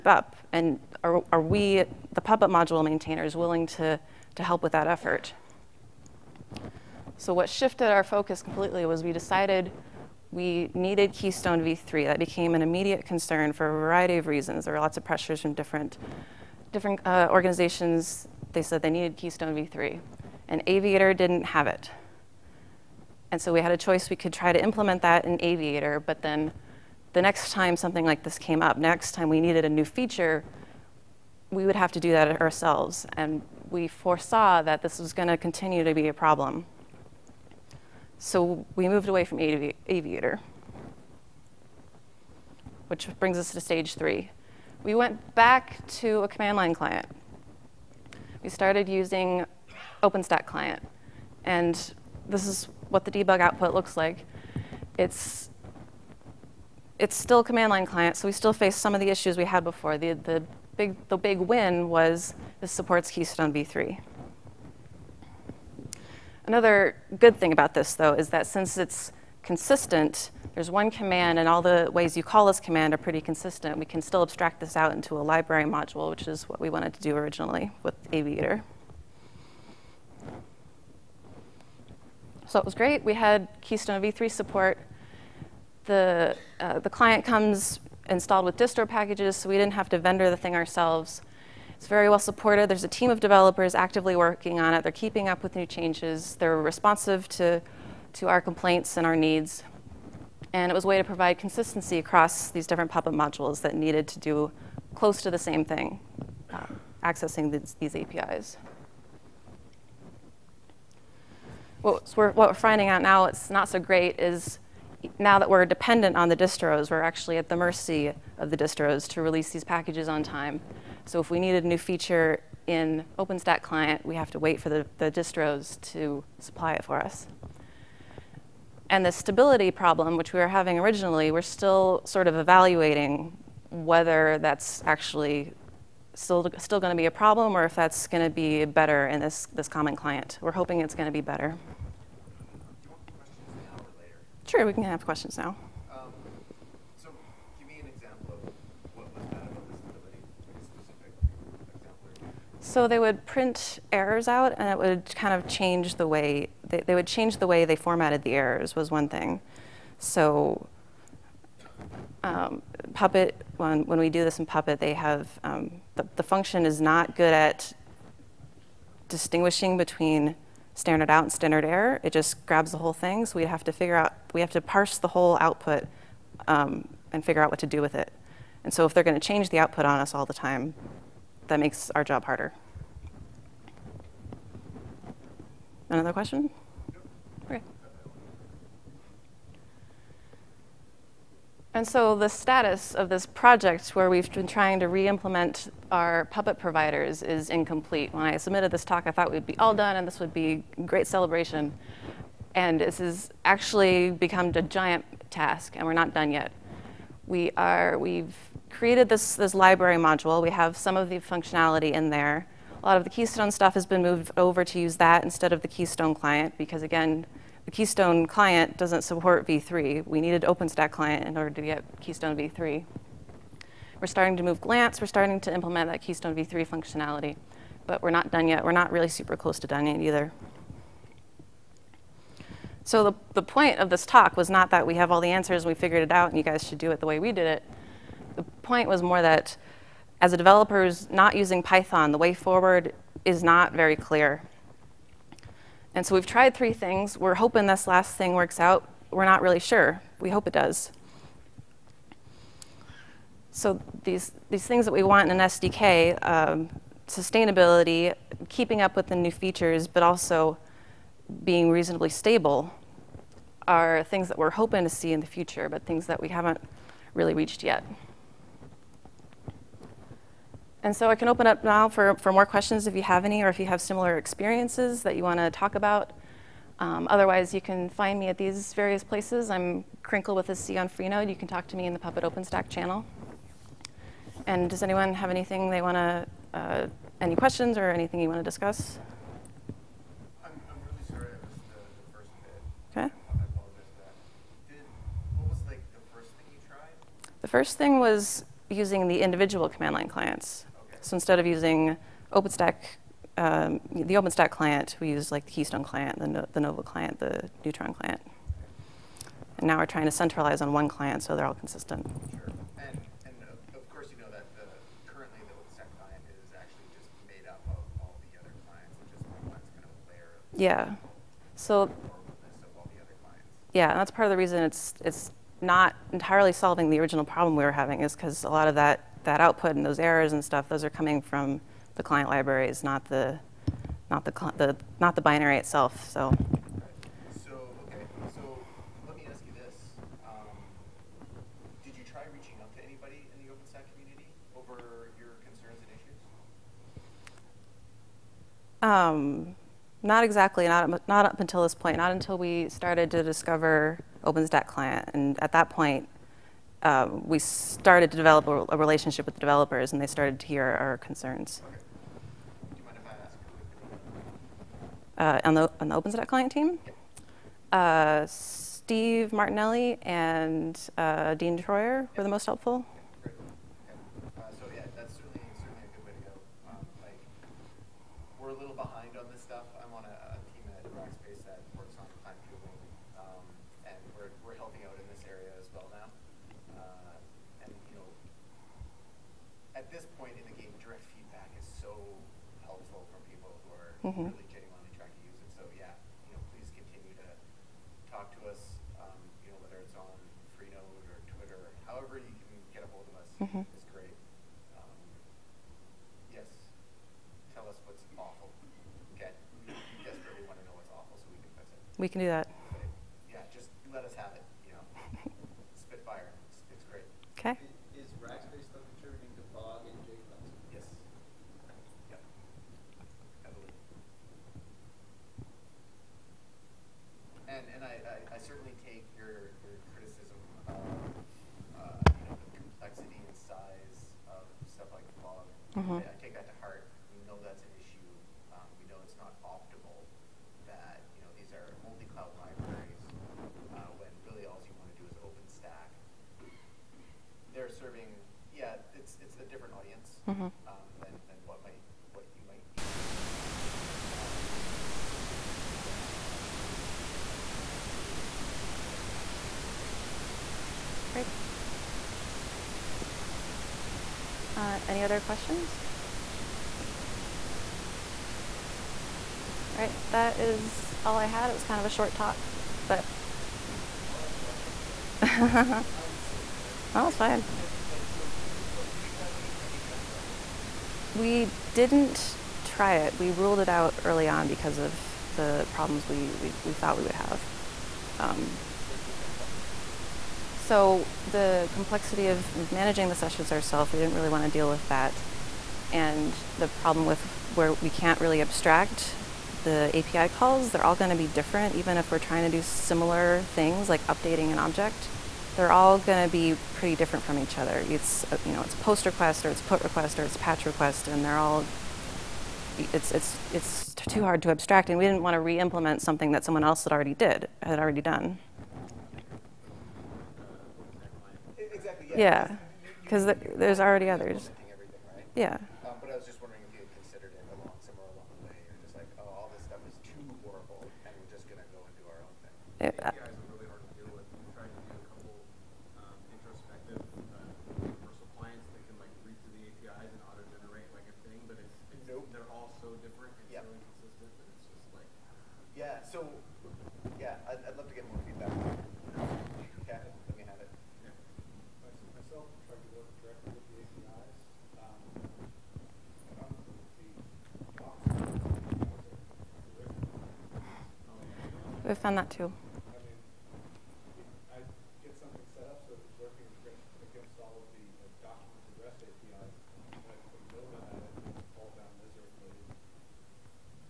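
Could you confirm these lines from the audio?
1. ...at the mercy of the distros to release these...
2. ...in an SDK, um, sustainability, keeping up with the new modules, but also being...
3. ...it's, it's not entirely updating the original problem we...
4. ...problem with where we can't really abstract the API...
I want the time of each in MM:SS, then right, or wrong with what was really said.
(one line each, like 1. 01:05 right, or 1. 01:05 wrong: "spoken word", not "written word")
1. 01:57 right
2. 04:15 wrong: "features", not "modules"
3. 05:24 wrong: "solving", not "updating"
4. 08:16 right.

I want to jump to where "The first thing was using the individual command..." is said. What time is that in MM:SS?
04:57.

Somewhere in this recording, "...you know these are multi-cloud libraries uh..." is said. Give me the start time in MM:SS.
07:21.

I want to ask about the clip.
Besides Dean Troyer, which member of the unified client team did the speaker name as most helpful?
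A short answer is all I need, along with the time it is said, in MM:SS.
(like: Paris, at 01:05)
Steve Martinelli, at 06:08.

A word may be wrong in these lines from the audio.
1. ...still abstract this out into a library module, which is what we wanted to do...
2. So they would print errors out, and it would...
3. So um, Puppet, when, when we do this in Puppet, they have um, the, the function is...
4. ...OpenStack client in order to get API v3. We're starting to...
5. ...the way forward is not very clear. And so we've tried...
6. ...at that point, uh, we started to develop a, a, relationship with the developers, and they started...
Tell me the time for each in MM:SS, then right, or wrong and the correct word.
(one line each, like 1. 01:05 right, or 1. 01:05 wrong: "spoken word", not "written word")
1. 01:14 right
2. 02:32 right
3. 02:39 right
4. 03:40 wrong: "Keystone", not "API"
5. 04:02 right
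6. 05:55 right.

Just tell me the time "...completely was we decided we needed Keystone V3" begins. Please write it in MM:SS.
00:08.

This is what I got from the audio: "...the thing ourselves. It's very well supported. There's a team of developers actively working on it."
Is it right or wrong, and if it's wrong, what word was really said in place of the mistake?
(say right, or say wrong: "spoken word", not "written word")
right.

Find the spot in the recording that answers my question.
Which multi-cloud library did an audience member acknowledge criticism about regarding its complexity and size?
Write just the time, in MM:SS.
07:15.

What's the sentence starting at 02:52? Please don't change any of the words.
It just grabs the whole thing.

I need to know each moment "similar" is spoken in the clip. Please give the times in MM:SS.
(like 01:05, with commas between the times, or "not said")
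04:33, 08:22.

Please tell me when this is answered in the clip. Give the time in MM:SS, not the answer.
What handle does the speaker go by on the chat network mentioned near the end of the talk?
04:40.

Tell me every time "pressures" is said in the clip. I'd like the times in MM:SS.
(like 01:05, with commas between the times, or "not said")
00:15.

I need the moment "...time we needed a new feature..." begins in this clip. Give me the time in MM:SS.
00:29.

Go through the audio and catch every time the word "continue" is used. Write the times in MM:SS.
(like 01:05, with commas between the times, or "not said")
00:35, 06:36.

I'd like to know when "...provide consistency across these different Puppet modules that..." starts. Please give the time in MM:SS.
01:41.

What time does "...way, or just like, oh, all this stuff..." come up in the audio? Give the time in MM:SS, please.
08:48.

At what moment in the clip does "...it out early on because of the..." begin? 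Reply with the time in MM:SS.
08:03.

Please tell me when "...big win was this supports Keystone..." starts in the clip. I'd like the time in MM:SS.
01:01.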